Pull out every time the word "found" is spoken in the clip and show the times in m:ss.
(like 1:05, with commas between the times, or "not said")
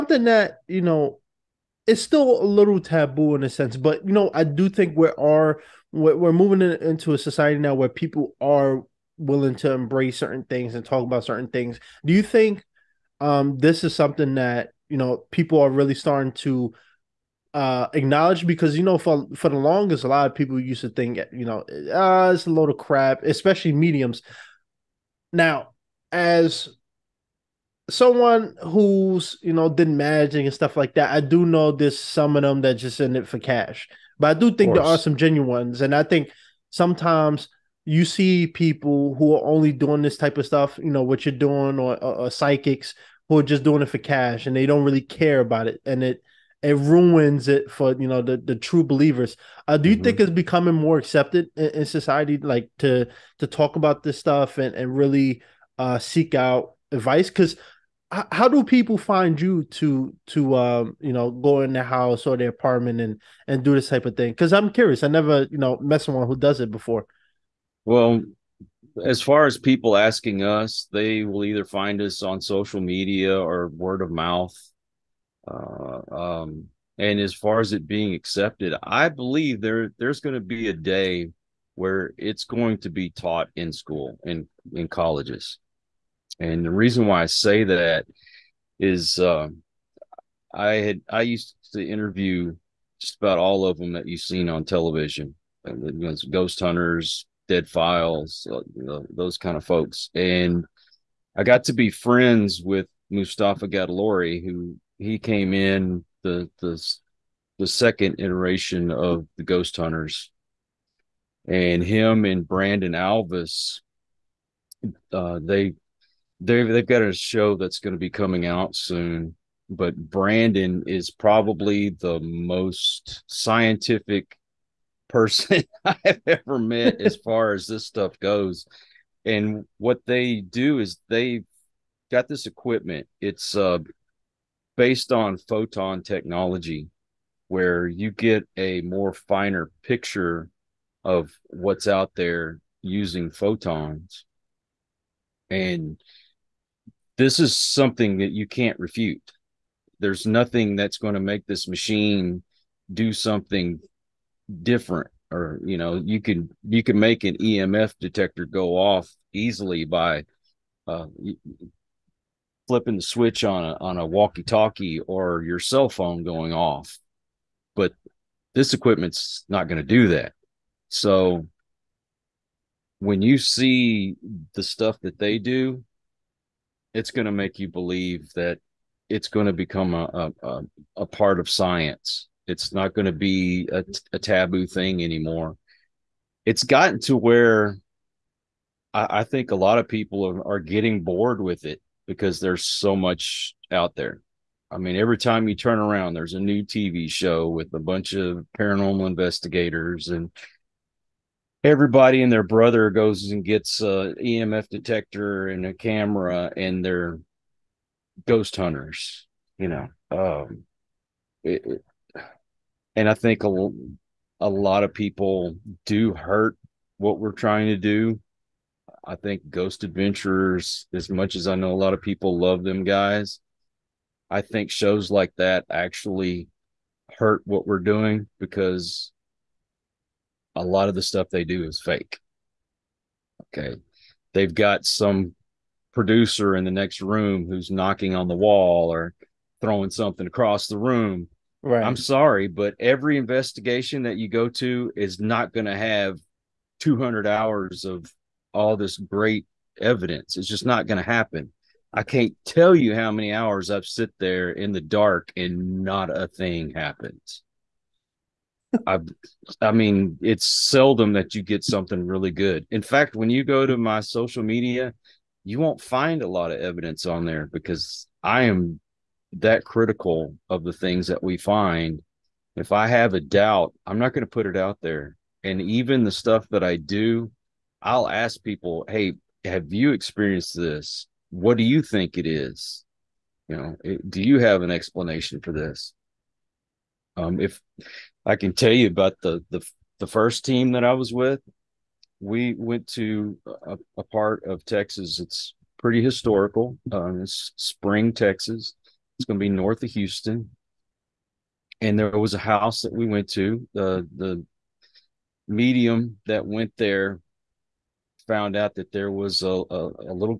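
5:08.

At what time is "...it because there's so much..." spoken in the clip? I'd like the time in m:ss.
3:11.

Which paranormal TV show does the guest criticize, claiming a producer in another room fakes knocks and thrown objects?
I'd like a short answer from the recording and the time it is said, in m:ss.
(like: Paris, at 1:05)
Ghost Adventurers, at 3:39.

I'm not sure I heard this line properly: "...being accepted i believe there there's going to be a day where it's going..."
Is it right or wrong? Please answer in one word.
right.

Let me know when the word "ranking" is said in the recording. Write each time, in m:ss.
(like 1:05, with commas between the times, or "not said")
not said.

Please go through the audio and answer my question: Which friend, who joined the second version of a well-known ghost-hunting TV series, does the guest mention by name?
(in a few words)
Mustafa Gatollari.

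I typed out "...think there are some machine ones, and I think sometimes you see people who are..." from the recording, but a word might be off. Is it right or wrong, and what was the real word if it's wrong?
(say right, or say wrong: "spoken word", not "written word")
wrong: "genuine", not "machine".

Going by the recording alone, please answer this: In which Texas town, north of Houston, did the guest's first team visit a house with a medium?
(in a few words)
Spring, Texas.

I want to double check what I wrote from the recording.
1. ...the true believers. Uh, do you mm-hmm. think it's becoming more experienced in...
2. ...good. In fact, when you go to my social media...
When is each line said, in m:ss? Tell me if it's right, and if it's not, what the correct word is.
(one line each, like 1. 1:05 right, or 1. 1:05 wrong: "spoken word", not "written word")
1. 0:48 wrong: "accepted", not "experienced"
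2. 4:22 right.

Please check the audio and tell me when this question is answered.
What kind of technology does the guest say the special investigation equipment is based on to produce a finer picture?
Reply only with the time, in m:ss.
2:15.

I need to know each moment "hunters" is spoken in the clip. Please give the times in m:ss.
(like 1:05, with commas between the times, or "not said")
1:36, 1:49, 3:28.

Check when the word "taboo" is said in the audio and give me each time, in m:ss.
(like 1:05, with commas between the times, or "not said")
0:02, 3:04.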